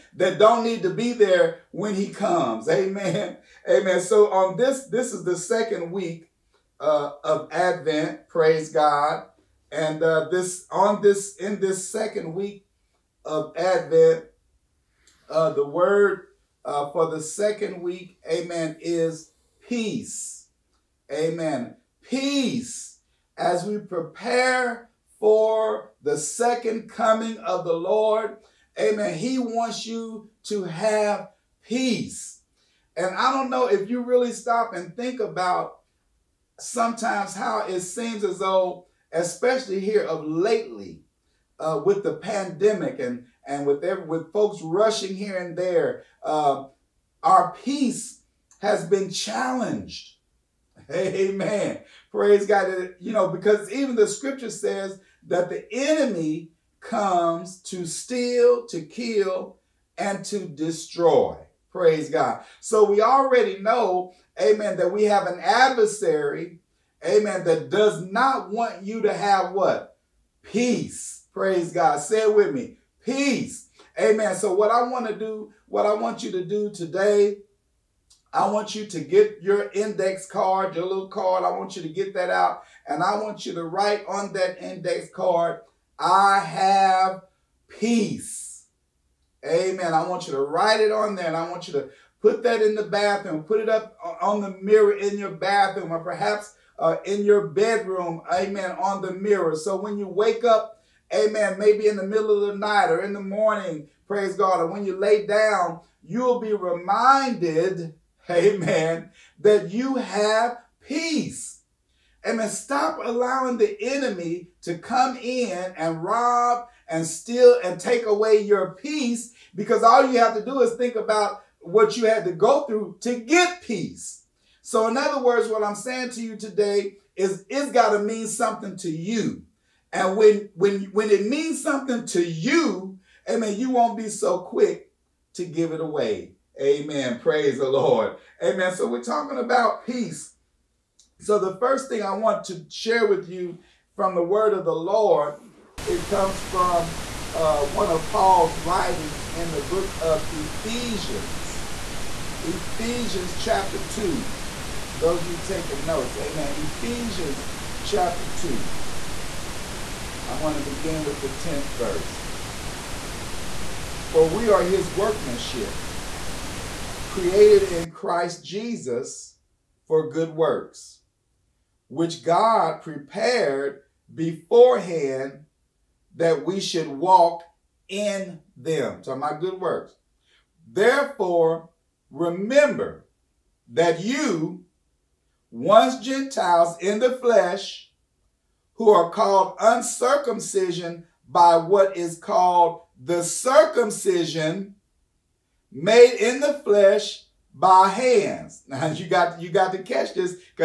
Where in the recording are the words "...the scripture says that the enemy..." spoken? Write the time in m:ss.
0:53.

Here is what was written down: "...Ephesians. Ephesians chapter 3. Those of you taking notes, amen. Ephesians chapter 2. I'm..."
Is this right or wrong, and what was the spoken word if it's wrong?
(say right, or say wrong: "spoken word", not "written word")
wrong: "2", not "3".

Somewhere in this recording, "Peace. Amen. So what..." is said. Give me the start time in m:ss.
1:13.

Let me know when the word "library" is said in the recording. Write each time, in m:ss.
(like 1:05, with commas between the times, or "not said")
not said.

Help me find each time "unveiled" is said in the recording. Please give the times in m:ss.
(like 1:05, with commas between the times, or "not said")
not said.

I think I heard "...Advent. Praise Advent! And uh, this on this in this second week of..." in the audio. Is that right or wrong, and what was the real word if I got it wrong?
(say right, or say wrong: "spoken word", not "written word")
wrong: "God", not "Advent".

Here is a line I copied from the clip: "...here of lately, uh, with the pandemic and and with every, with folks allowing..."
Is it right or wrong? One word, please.
wrong.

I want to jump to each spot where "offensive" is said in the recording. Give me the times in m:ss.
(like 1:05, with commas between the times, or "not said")
not said.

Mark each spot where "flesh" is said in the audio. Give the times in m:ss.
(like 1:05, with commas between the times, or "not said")
3:07, 3:16.